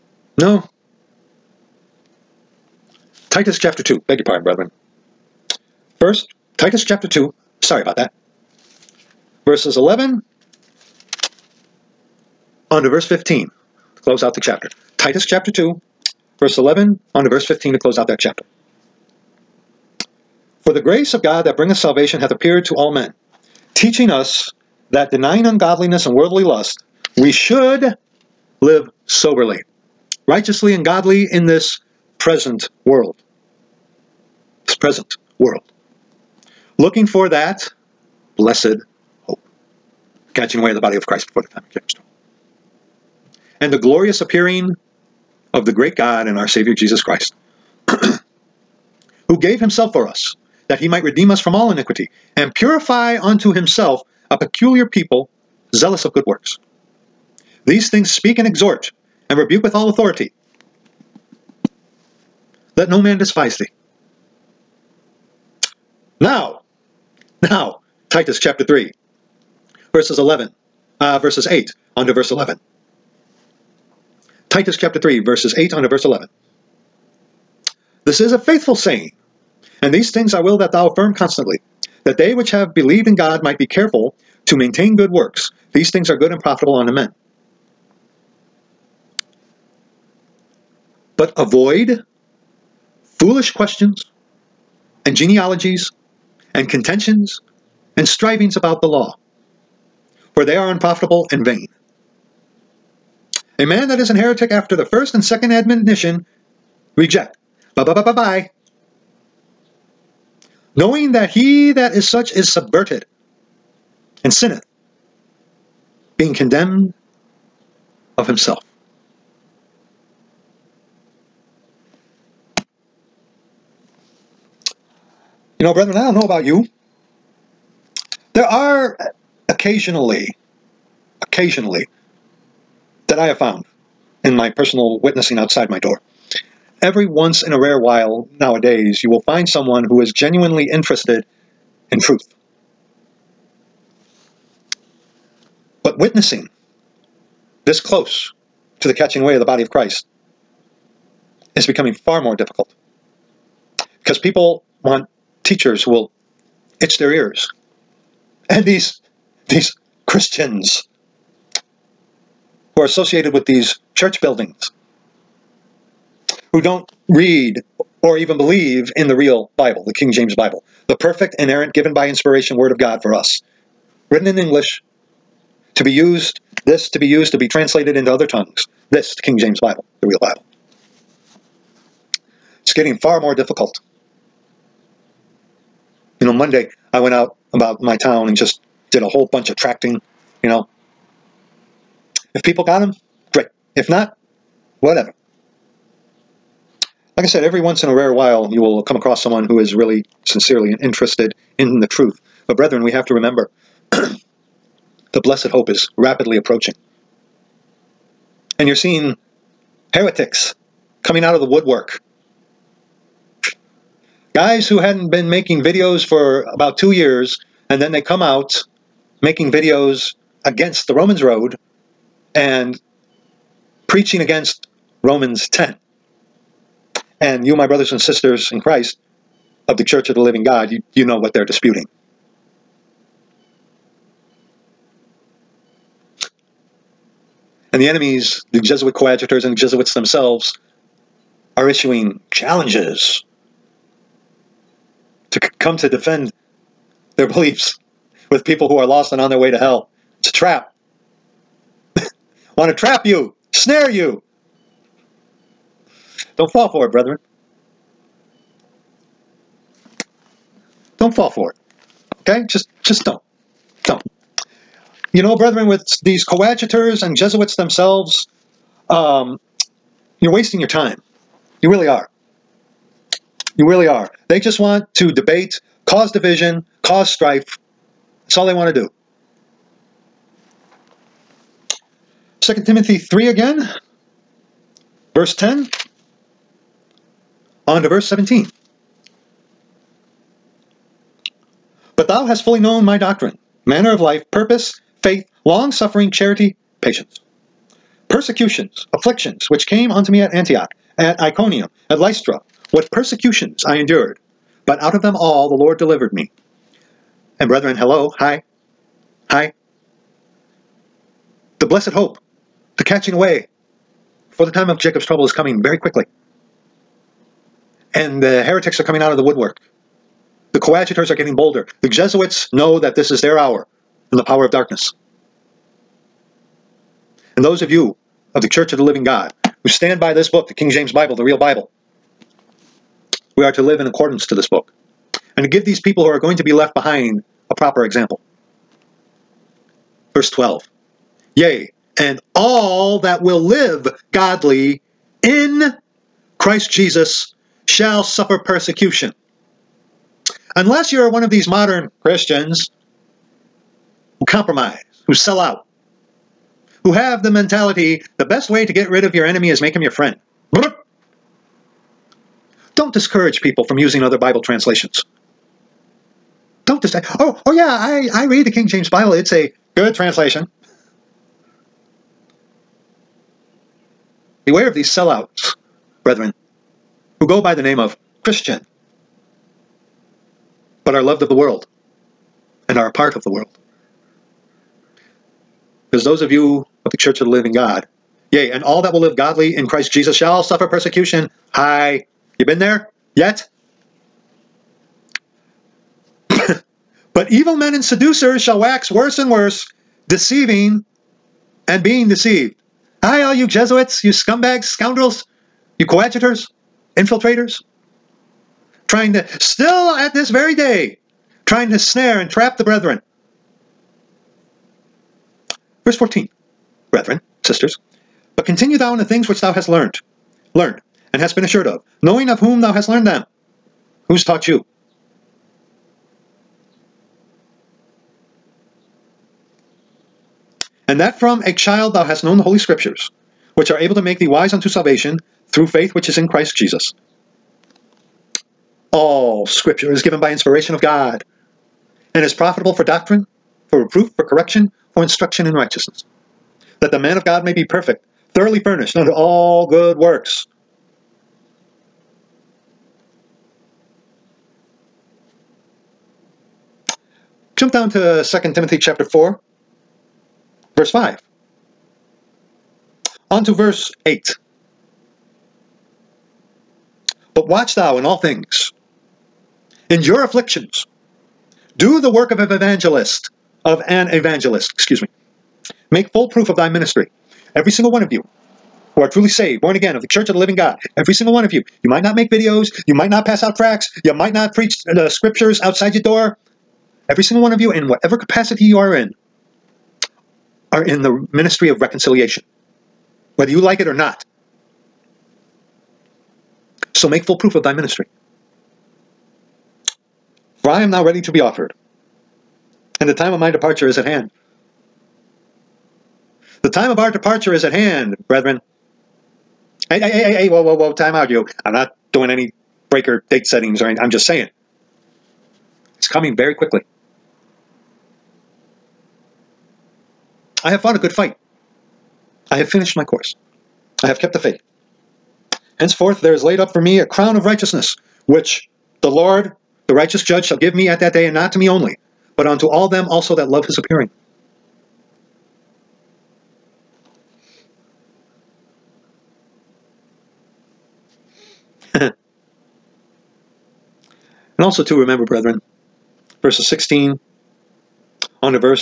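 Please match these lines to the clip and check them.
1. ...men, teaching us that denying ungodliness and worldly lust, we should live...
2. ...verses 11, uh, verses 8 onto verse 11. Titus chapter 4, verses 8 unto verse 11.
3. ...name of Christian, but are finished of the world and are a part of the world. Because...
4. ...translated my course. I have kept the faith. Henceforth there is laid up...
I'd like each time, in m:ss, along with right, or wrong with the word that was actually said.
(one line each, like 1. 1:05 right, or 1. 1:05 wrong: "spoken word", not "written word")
1. 0:22 right
2. 1:09 wrong: "3", not "4"
3. 6:17 wrong: "loved", not "finished"
4. 8:42 wrong: "finished", not "translated".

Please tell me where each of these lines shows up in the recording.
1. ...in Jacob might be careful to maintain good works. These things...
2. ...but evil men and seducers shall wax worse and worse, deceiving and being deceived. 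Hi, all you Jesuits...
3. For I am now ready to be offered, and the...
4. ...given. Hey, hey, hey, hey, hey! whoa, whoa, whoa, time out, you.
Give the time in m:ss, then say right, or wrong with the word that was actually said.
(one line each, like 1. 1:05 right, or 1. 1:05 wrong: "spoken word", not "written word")
1. 1:23 wrong: "God", not "Jacob"
2. 6:36 right
3. 8:20 right
4. 8:28 wrong: "brethren", not "given".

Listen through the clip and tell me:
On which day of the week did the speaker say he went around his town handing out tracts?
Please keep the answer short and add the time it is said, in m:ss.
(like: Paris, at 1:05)
Monday, at 3:06.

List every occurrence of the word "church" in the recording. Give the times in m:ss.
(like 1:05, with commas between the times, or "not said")
2:43, 3:49, 5:28, 6:26, 8:00.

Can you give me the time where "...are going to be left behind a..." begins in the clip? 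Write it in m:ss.
5:36.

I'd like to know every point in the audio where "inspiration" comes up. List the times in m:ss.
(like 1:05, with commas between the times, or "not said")
2:52, 7:20.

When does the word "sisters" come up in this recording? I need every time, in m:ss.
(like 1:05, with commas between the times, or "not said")
3:47, 6:57.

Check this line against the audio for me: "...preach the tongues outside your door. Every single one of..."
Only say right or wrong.
wrong.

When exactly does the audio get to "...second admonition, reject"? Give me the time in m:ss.
1:45.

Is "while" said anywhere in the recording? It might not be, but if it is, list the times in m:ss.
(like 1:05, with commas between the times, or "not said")
2:17, 3:18.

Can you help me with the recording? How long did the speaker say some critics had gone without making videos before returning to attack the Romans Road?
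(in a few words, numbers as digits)
about two years.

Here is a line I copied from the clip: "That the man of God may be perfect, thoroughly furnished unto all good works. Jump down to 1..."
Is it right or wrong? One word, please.
wrong.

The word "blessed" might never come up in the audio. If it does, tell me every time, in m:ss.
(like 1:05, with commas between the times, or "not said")
0:38, 3:25, 5:11.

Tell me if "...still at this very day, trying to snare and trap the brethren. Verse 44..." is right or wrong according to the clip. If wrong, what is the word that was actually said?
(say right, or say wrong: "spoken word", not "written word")
wrong: "14", not "44".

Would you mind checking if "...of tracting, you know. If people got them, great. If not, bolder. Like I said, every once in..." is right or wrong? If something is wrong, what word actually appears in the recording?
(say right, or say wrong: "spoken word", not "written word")
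wrong: "whatever", not "bolder".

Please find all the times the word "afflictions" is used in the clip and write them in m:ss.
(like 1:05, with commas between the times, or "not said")
4:58, 7:50.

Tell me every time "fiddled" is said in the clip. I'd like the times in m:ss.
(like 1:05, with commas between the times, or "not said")
not said.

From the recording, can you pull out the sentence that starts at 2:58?
This, the King James Bible, the real Bible.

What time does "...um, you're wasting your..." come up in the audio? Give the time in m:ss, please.
4:28.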